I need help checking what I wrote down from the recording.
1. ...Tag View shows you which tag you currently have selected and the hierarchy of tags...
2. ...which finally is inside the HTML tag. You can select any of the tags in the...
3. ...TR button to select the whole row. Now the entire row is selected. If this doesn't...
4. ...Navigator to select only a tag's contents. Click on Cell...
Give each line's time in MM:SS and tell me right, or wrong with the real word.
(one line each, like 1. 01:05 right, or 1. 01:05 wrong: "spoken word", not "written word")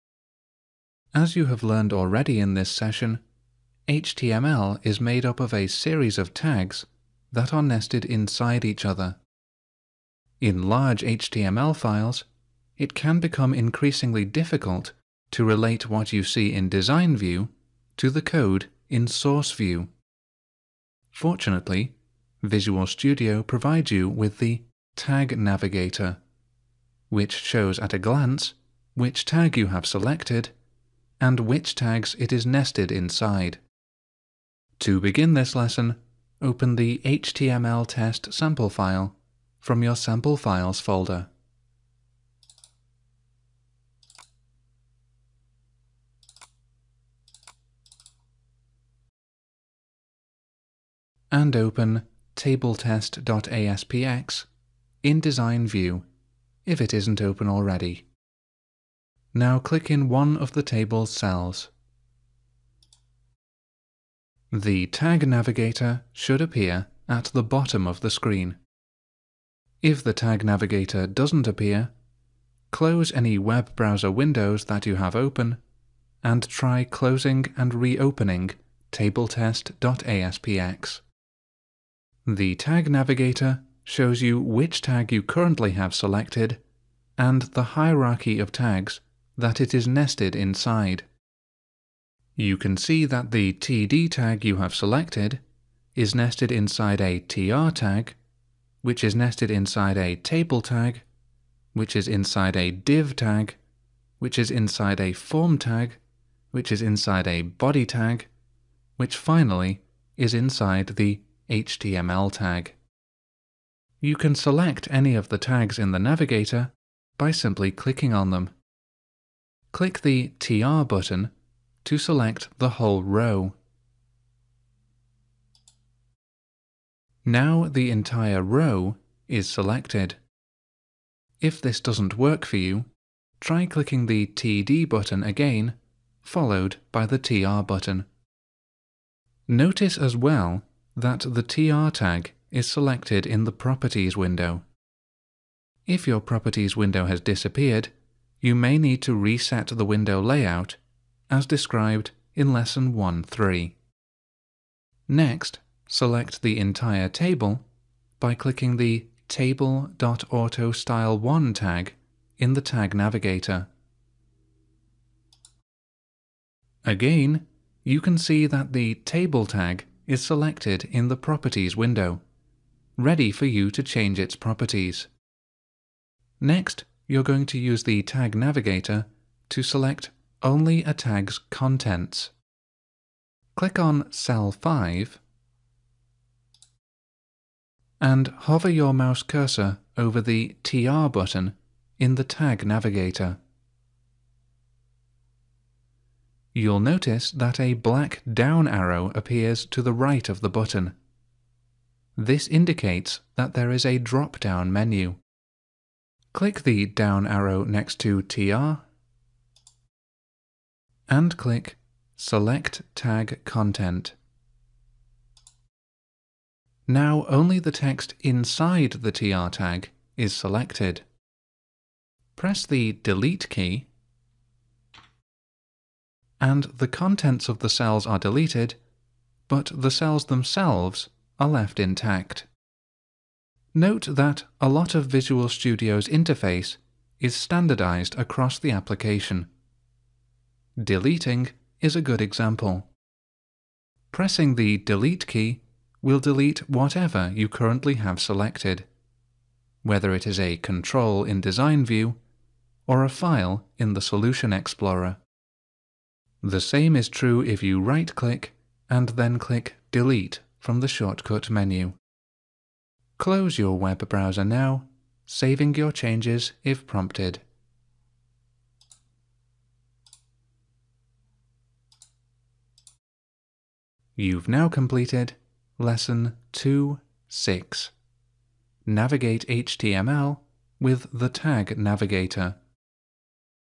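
1. 01:22 wrong: "Navigator", not "View"
2. 01:48 right
3. 02:00 right
4. 02:58 right.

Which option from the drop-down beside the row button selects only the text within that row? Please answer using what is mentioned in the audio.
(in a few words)
Select Tag Content.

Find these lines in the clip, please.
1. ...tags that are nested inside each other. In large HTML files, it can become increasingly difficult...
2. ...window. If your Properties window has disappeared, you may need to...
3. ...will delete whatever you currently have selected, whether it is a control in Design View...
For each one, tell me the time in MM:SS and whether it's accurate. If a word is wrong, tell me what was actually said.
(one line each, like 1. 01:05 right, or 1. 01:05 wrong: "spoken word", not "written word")
1. 00:06 right
2. 02:24 right
3. 04:06 right.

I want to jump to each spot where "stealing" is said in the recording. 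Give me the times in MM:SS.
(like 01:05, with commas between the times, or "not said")
not said.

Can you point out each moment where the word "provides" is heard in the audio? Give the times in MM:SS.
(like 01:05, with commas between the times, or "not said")
00:23.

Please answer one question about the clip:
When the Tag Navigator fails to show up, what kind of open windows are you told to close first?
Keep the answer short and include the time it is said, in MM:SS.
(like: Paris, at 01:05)
Web browser windows, at 01:13.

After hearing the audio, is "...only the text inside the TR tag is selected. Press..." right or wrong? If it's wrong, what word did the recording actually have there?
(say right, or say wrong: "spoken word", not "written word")
right.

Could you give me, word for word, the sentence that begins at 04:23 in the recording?
Close your web browser now, saving your changes if prompted.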